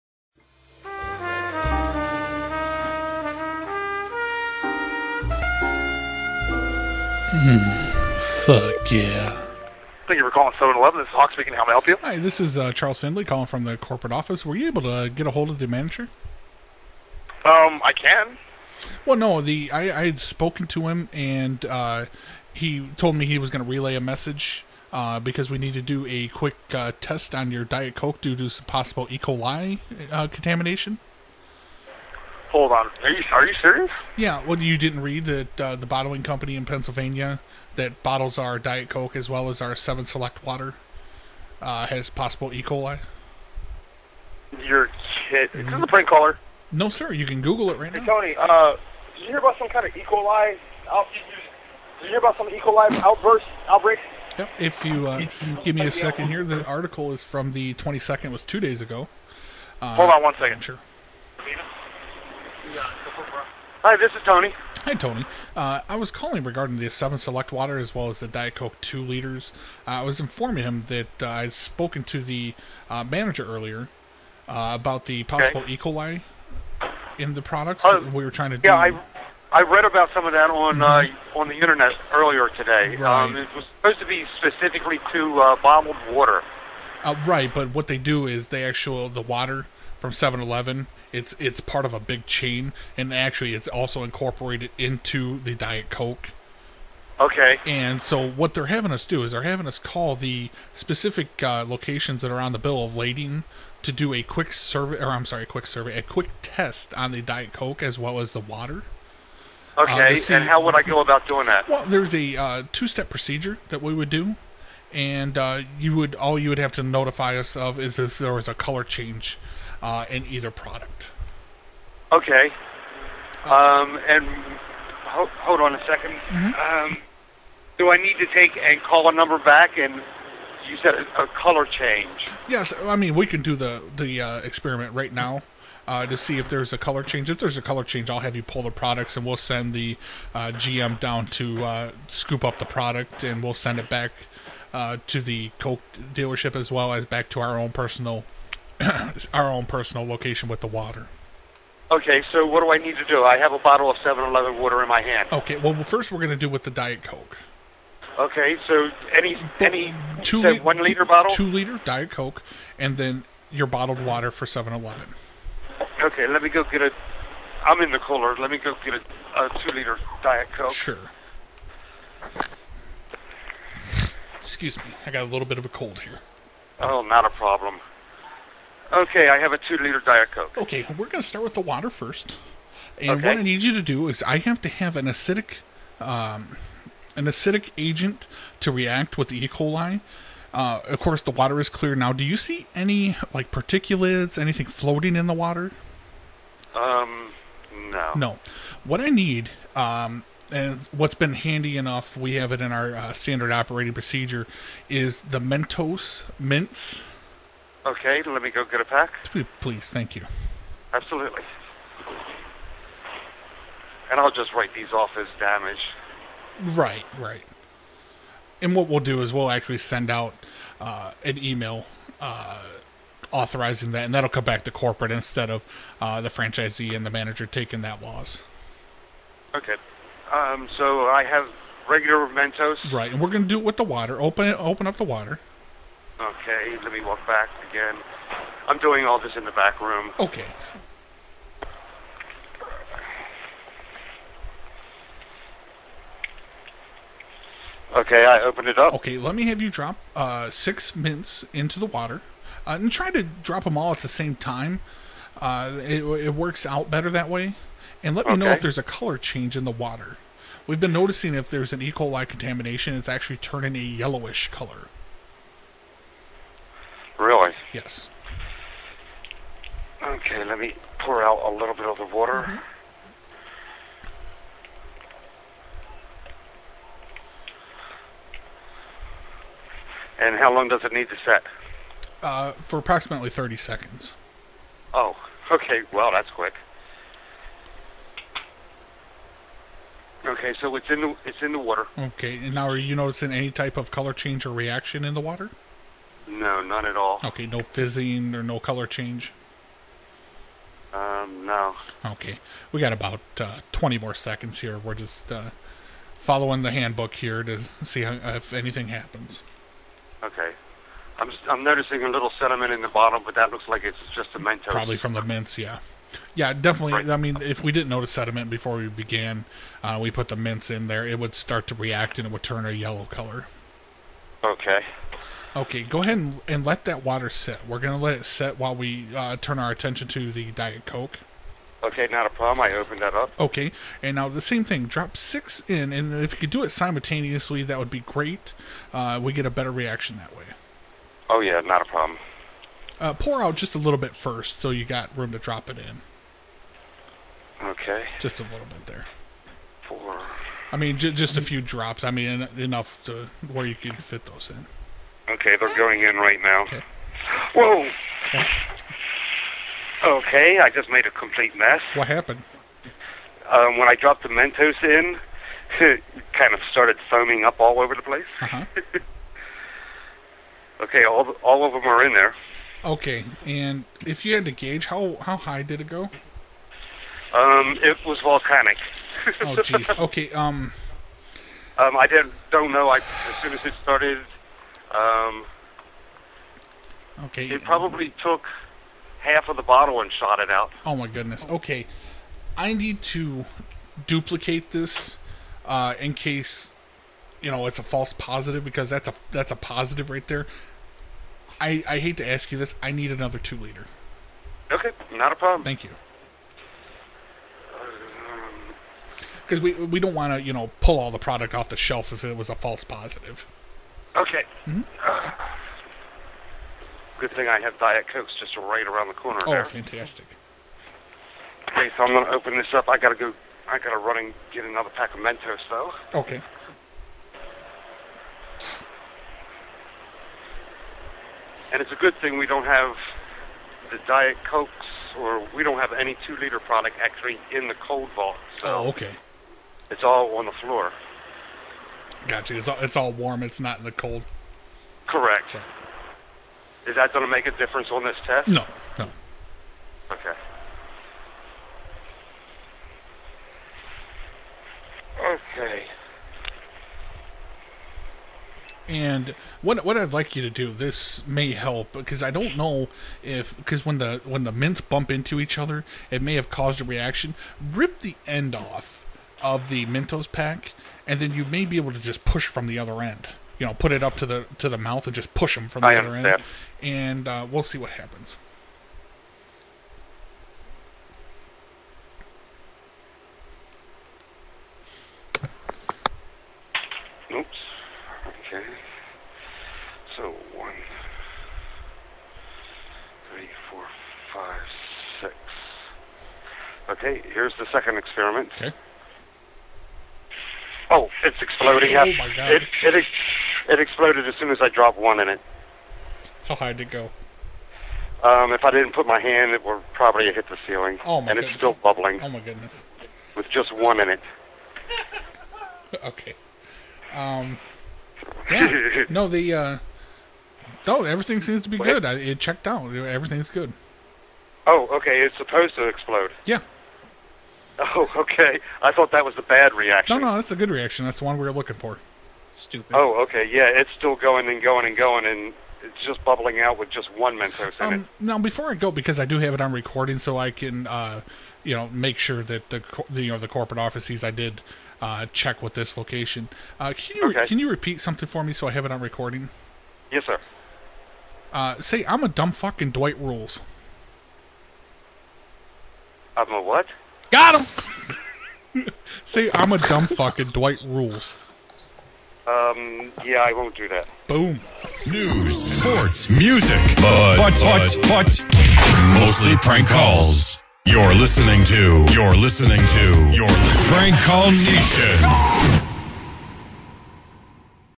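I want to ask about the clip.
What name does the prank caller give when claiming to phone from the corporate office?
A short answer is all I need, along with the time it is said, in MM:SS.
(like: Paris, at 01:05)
Charles Findley, at 00:12.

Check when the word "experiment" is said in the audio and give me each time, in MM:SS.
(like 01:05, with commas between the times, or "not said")
02:14, 08:17.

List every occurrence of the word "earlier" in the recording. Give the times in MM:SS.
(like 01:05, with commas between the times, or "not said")
01:13, 01:22.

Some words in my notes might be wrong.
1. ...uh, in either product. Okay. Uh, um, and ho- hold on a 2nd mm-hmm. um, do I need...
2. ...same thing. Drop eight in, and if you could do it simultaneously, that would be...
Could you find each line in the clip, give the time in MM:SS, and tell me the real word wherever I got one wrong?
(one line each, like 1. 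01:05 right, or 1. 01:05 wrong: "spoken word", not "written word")
1. 01:59 right
2. 05:34 wrong: "six", not "eight".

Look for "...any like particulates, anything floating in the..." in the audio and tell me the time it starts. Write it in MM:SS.
03:12.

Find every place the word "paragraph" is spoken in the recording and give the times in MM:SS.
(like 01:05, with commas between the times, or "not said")
not said.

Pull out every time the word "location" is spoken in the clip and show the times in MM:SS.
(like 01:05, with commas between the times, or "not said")
01:41, 02:30, 09:05.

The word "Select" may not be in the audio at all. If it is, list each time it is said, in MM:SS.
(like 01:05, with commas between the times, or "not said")
00:40, 01:07.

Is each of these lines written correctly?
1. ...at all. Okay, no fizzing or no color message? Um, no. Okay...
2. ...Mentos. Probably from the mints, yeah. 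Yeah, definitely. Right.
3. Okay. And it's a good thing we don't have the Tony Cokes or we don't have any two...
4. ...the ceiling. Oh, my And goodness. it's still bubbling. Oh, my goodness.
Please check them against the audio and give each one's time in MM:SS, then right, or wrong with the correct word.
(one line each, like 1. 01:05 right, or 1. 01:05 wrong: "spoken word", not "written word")
1. 04:56 wrong: "change", not "message"
2. 05:14 right
3. 07:06 wrong: "Diet", not "Tony"
4. 08:30 right.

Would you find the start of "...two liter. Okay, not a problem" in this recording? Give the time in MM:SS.
06:43.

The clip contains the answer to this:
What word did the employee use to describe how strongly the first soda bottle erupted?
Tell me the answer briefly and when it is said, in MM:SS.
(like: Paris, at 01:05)
Volcanic, at 06:18.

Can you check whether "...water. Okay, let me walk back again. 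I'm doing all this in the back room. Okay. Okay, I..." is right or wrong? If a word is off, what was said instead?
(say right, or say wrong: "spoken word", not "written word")
right.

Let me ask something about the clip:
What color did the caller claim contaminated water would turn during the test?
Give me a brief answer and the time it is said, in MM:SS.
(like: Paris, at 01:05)
Yellowish, at 04:23.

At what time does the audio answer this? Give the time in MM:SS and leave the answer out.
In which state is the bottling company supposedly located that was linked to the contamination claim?
00:36.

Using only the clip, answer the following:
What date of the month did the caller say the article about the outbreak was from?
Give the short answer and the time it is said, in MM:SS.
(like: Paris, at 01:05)
22nd, at 00:57.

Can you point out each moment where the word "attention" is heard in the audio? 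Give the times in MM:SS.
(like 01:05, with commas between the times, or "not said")
05:29.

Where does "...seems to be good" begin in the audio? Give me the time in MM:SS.
08:41.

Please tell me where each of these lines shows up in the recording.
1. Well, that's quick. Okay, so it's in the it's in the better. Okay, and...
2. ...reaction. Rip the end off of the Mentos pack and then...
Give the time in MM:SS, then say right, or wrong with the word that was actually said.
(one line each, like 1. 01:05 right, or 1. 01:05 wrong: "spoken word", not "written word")
1. 04:45 wrong: "water", not "better"
2. 07:46 right.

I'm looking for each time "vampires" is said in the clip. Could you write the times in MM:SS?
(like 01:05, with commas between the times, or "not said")
not said.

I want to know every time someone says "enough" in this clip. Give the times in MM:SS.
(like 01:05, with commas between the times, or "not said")
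03:21, 05:52.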